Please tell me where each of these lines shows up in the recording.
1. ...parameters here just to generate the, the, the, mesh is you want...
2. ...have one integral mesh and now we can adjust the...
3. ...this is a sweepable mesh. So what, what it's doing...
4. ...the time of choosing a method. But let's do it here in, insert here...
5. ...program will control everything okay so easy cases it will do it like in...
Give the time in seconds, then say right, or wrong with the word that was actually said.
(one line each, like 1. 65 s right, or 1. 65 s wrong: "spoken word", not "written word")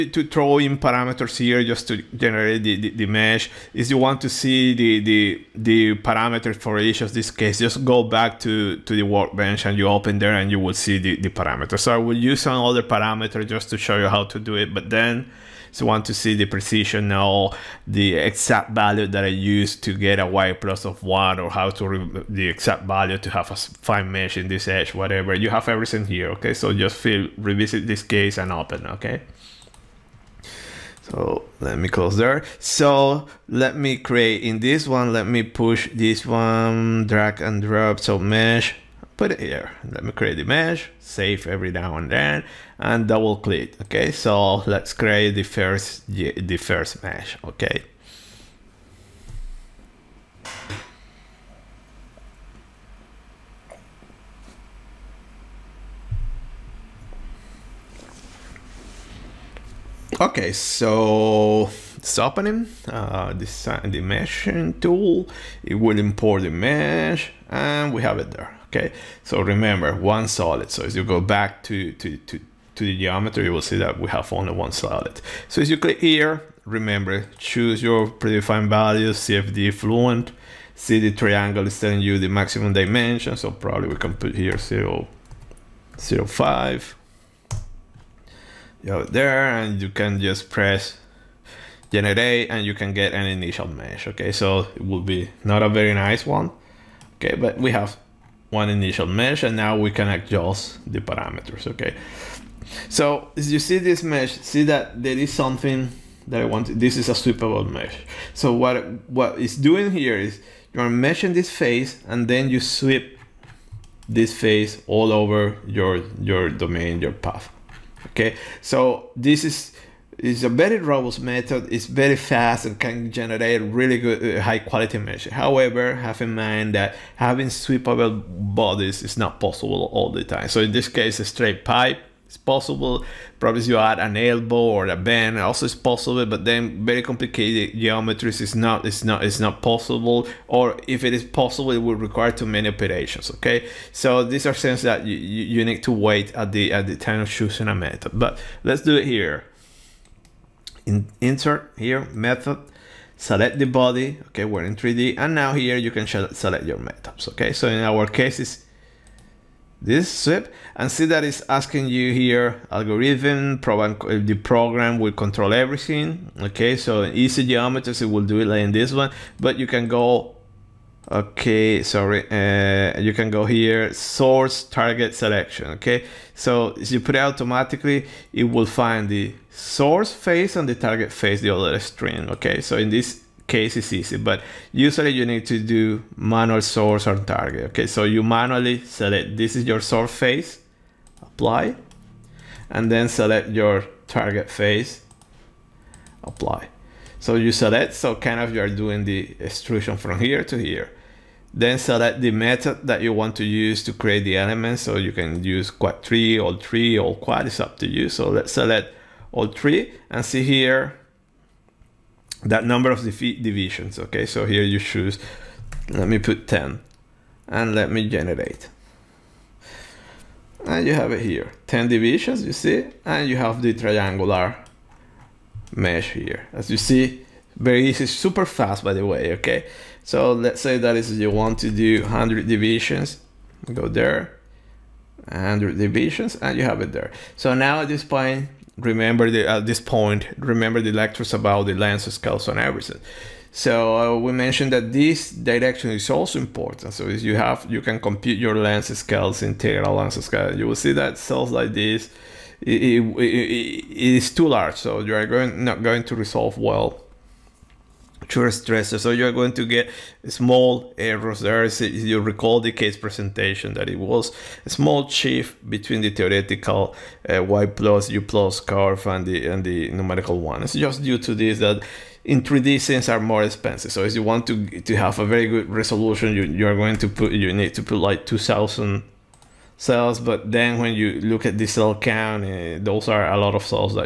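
1. 0 s right
2. 97 s wrong: "initial", not "integral"
3. 106 s right
4. 146 s right
5. 164 s wrong: "geometries", not "cases".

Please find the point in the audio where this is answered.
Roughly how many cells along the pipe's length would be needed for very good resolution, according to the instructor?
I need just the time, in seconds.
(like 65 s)
278 s.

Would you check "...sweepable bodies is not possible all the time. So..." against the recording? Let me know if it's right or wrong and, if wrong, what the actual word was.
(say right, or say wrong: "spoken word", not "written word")
right.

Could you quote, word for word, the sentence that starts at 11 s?
So I will use another parameter just to show you how to do it.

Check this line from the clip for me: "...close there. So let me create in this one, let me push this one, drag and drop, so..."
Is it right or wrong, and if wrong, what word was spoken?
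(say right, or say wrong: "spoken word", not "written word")
right.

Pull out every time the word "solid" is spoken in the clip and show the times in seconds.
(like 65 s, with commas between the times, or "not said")
70 s, 74 s.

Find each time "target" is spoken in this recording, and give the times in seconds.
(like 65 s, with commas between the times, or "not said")
174 s, 180 s, 187 s, 194 s.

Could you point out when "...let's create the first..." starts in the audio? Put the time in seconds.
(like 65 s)
44 s.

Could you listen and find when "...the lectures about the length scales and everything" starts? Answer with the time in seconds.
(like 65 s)
240 s.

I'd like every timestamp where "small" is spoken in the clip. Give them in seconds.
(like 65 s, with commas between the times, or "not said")
260 s, 264 s.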